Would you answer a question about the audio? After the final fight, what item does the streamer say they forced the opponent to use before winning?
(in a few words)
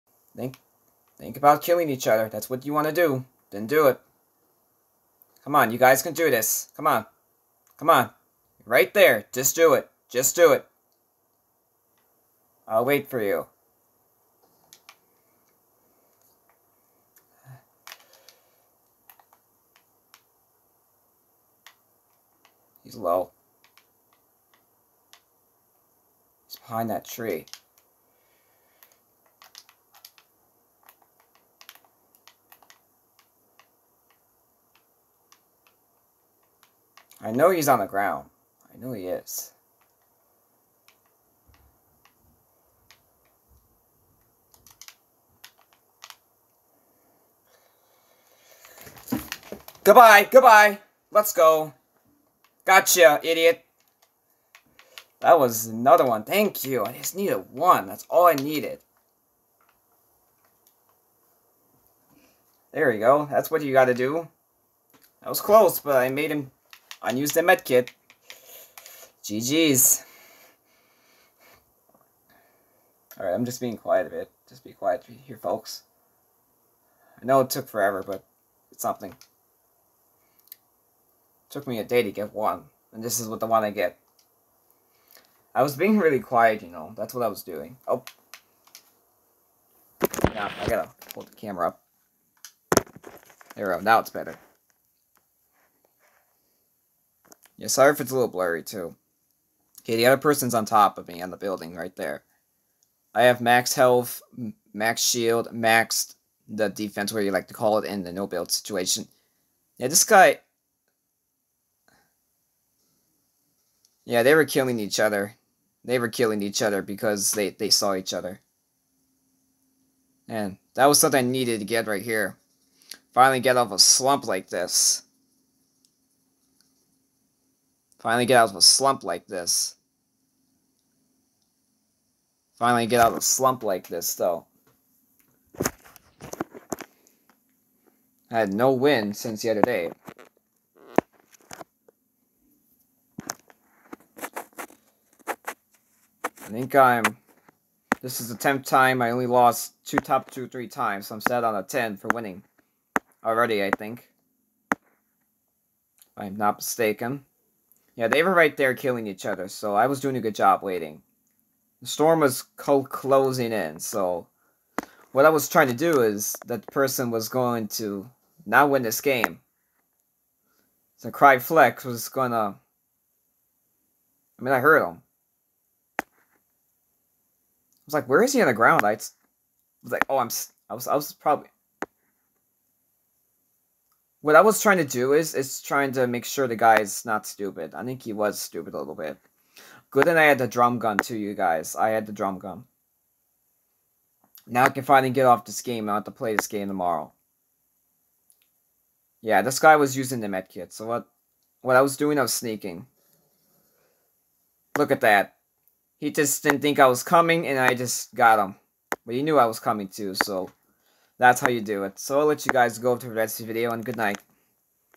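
medkit.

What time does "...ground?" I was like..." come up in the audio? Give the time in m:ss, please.
2:58.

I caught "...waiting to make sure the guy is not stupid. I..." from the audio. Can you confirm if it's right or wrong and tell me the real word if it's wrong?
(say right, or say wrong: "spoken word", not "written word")
wrong: "trying", not "waiting".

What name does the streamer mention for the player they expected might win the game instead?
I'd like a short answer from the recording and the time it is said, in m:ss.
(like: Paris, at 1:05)
Cry Flex, at 2:51.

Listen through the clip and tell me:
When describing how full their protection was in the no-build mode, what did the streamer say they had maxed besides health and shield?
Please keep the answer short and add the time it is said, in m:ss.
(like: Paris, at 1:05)
defense, at 1:46.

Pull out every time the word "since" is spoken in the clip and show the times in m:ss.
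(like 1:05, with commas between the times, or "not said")
2:19.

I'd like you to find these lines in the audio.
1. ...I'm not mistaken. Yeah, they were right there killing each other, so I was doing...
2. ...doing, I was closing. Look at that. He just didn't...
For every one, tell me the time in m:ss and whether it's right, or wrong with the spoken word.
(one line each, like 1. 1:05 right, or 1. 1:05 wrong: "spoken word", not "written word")
1. 2:36 right
2. 3:21 wrong: "sneaking", not "closing".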